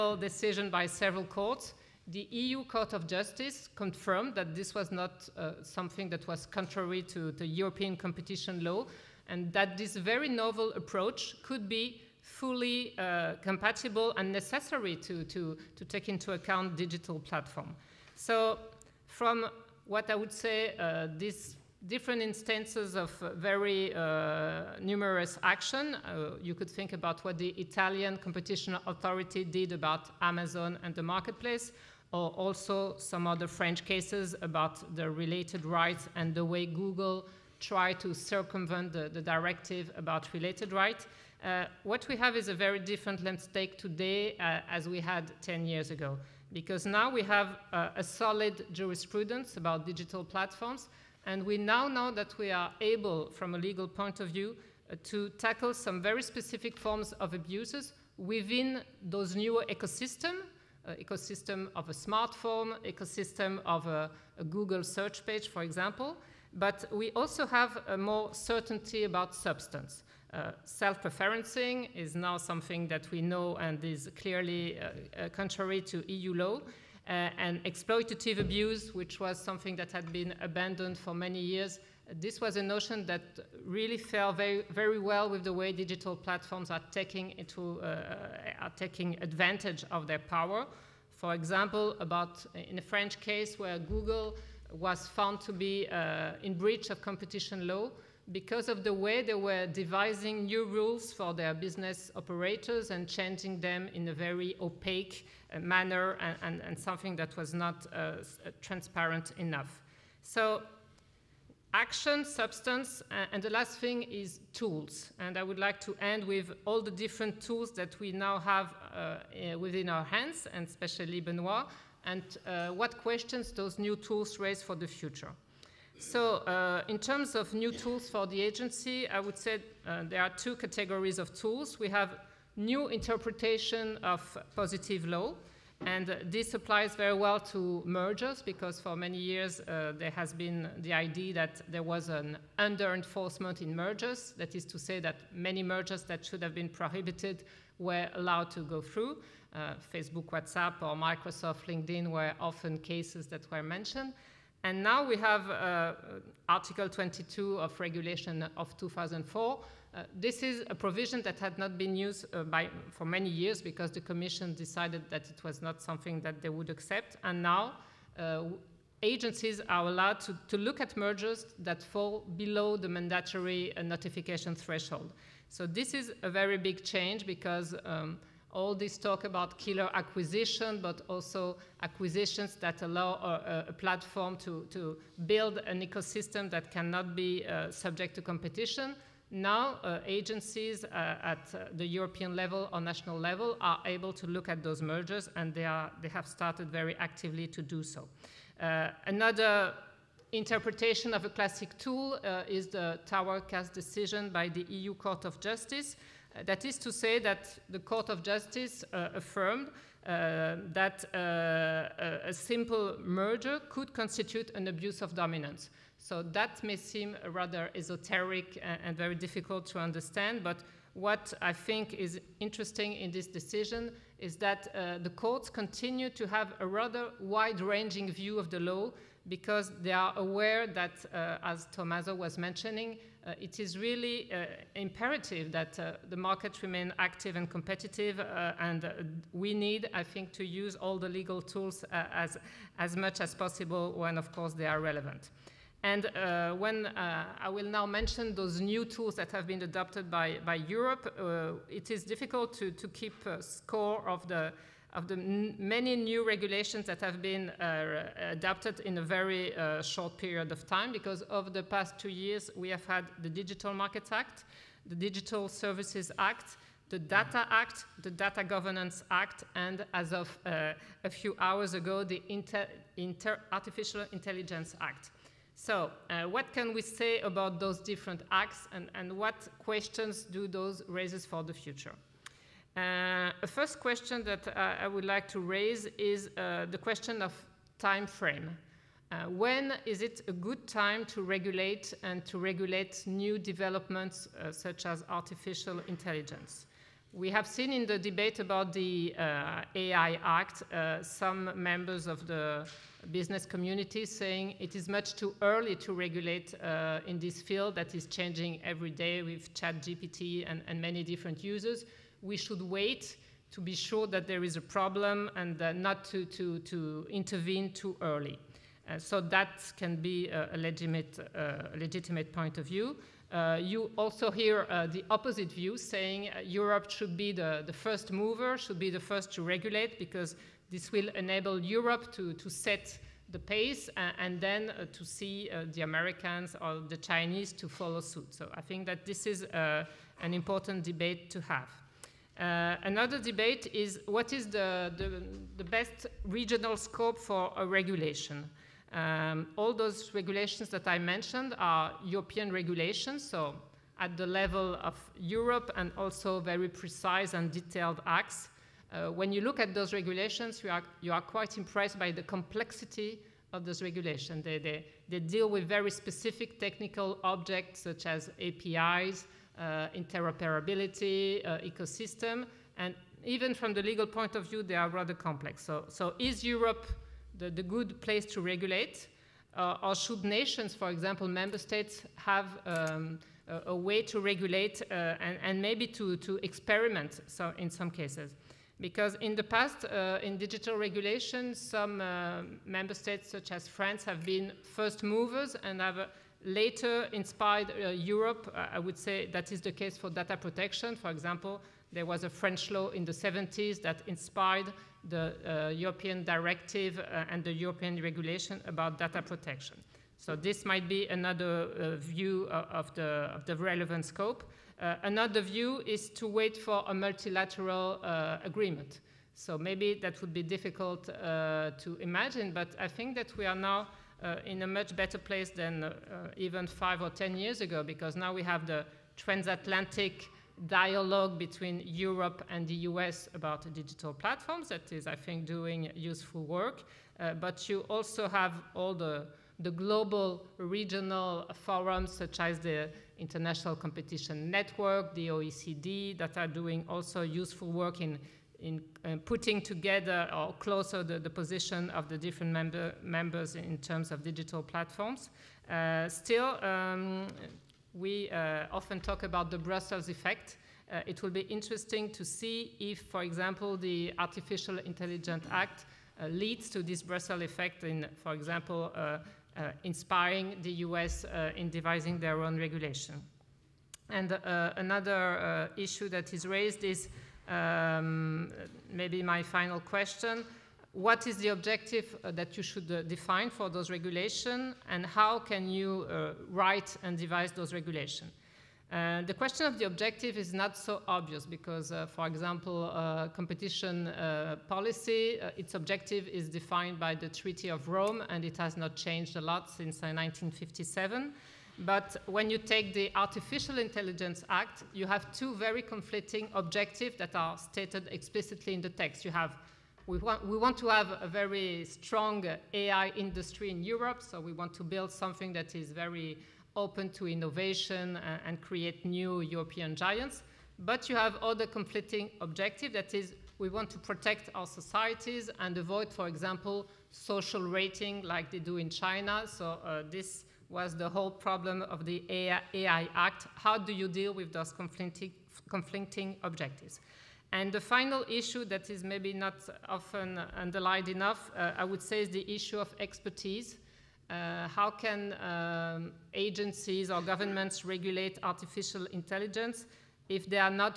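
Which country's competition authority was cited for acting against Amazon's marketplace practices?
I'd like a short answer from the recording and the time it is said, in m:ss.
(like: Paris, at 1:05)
Italian, at 0:27.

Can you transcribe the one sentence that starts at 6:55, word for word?
another view is to wait for a multilateral agreement.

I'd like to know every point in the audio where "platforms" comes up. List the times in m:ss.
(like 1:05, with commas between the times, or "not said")
0:17, 0:50, 1:26, 3:03, 7:14, 7:34.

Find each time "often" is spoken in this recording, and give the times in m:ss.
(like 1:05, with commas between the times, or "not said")
2:32, 7:38, 8:59.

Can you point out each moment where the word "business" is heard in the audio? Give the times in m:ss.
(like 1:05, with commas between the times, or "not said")
1:41, 5:03.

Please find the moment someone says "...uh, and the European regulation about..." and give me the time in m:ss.
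6:46.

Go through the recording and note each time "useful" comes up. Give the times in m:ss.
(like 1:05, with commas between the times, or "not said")
7:15, 7:27.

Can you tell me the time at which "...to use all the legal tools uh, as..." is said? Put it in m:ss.
4:00.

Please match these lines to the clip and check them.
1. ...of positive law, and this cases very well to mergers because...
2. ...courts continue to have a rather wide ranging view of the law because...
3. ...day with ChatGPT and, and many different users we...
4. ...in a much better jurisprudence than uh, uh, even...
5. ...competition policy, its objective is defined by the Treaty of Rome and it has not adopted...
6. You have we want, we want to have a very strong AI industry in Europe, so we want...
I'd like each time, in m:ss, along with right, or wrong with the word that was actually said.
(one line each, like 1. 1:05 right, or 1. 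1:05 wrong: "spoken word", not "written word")
1. 2:14 wrong: "applies", not "cases"
2. 3:45 right
3. 5:08 right
4. 7:04 wrong: "place", not "jurisprudence"
5. 8:13 wrong: "changed", not "adopted"
6. 8:29 right.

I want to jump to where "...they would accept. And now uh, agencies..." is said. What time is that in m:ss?
2:46.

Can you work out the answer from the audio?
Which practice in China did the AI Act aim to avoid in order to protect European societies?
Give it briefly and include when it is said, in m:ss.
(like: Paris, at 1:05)
Social rating, at 8:47.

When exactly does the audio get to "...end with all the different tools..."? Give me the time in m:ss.
1:56.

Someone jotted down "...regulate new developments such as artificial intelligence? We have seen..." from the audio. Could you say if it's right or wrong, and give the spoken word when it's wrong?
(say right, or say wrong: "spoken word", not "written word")
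right.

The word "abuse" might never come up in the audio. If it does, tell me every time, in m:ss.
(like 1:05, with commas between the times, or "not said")
0:57, 1:18, 3:34.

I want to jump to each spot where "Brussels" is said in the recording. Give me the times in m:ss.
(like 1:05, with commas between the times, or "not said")
7:39, 7:47.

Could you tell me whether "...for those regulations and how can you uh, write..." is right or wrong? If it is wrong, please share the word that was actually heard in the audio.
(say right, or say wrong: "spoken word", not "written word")
right.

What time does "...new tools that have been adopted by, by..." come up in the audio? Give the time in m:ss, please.
4:08.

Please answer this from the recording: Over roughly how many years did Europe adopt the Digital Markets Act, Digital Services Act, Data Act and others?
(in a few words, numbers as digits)
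2.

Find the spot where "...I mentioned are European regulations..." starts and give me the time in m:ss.
5:50.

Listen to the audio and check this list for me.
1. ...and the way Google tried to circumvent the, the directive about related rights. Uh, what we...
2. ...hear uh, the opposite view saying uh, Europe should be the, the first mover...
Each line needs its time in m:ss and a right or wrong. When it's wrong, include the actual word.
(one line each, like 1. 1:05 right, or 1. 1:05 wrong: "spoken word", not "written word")
1. 0:36 right
2. 5:24 right.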